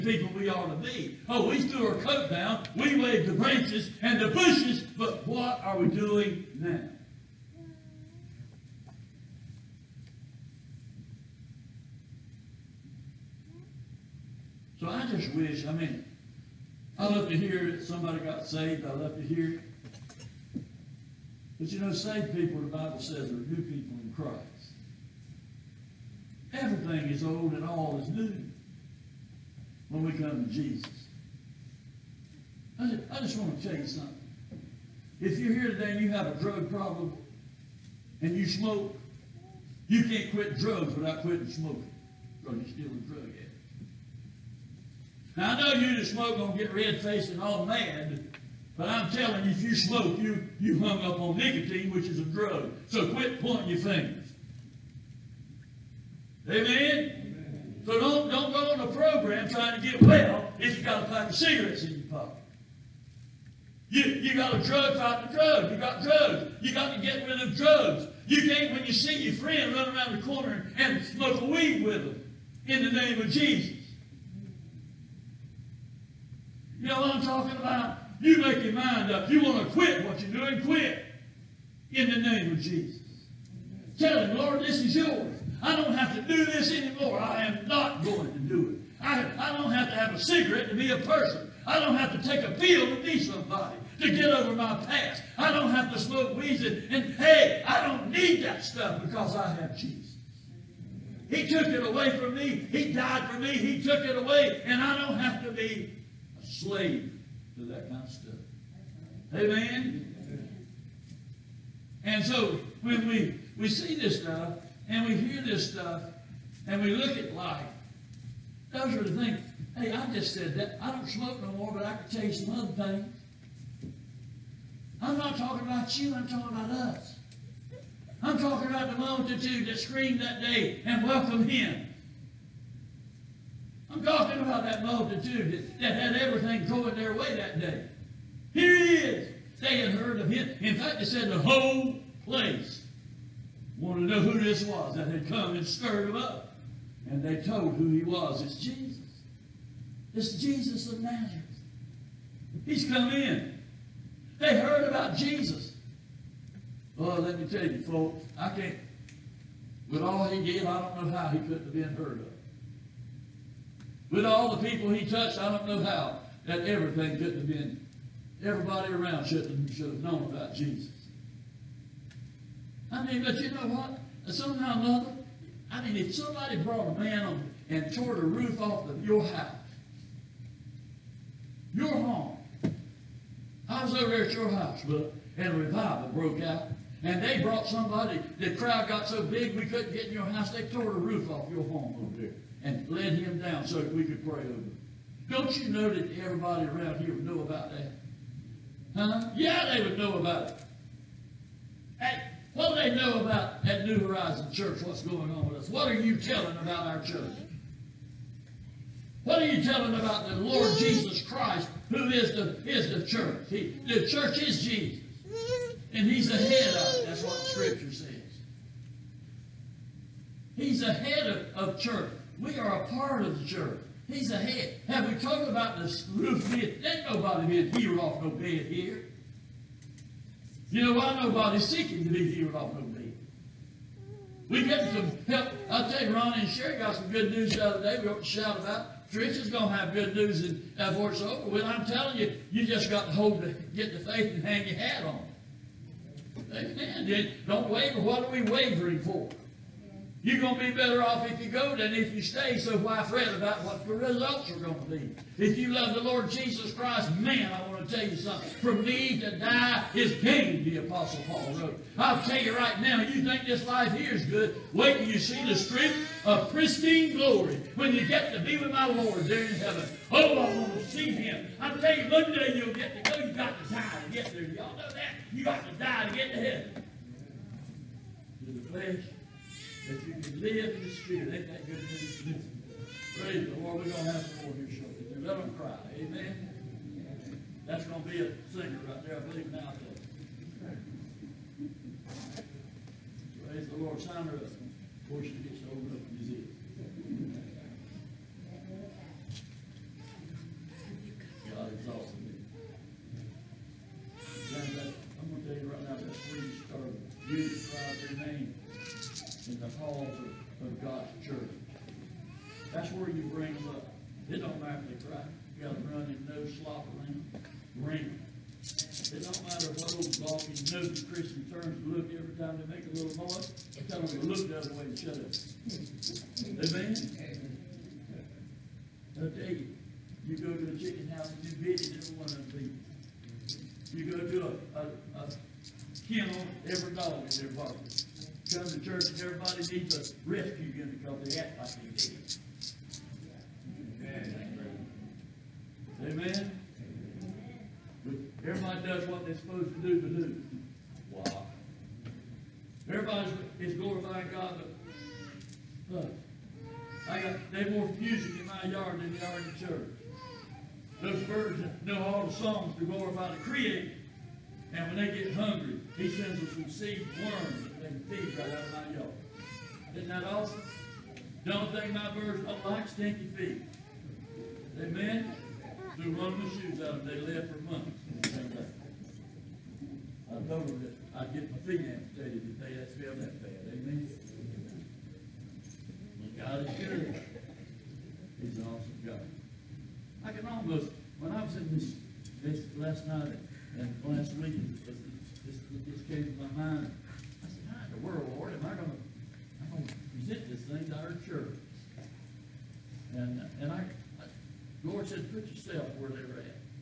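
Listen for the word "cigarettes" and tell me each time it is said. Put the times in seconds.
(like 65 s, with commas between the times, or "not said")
61 s, 90 s.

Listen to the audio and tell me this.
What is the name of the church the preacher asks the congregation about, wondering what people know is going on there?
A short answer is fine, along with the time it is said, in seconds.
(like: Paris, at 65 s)
New Horizon Church, at 203 s.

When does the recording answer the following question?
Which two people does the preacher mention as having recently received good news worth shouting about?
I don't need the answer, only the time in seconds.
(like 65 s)
236 s.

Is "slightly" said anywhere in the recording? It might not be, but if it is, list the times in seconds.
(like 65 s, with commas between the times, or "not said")
not said.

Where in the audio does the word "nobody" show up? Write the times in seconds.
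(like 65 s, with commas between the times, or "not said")
227 s, 231 s.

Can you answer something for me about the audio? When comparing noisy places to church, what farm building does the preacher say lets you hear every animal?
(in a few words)
Chicken house.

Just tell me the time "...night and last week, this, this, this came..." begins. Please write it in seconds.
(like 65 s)
393 s.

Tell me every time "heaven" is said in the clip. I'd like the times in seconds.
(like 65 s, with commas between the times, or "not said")
269 s, 276 s.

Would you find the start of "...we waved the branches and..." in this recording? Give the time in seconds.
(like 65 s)
2 s.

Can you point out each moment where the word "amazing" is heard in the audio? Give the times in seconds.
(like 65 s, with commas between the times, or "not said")
not said.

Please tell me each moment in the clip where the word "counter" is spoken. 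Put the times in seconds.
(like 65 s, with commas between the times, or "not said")
not said.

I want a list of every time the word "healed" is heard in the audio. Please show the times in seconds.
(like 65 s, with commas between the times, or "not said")
227 s, 232 s.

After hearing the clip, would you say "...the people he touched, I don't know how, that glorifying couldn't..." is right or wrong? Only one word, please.
wrong.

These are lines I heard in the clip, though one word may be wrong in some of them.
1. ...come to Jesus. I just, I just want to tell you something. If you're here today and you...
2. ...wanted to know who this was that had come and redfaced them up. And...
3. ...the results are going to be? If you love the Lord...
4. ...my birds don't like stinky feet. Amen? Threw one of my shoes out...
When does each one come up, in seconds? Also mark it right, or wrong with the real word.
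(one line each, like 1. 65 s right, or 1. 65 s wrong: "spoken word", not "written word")
1. 30 s right
2. 143 s wrong: "stirred", not "redfaced"
3. 253 s right
4. 371 s right.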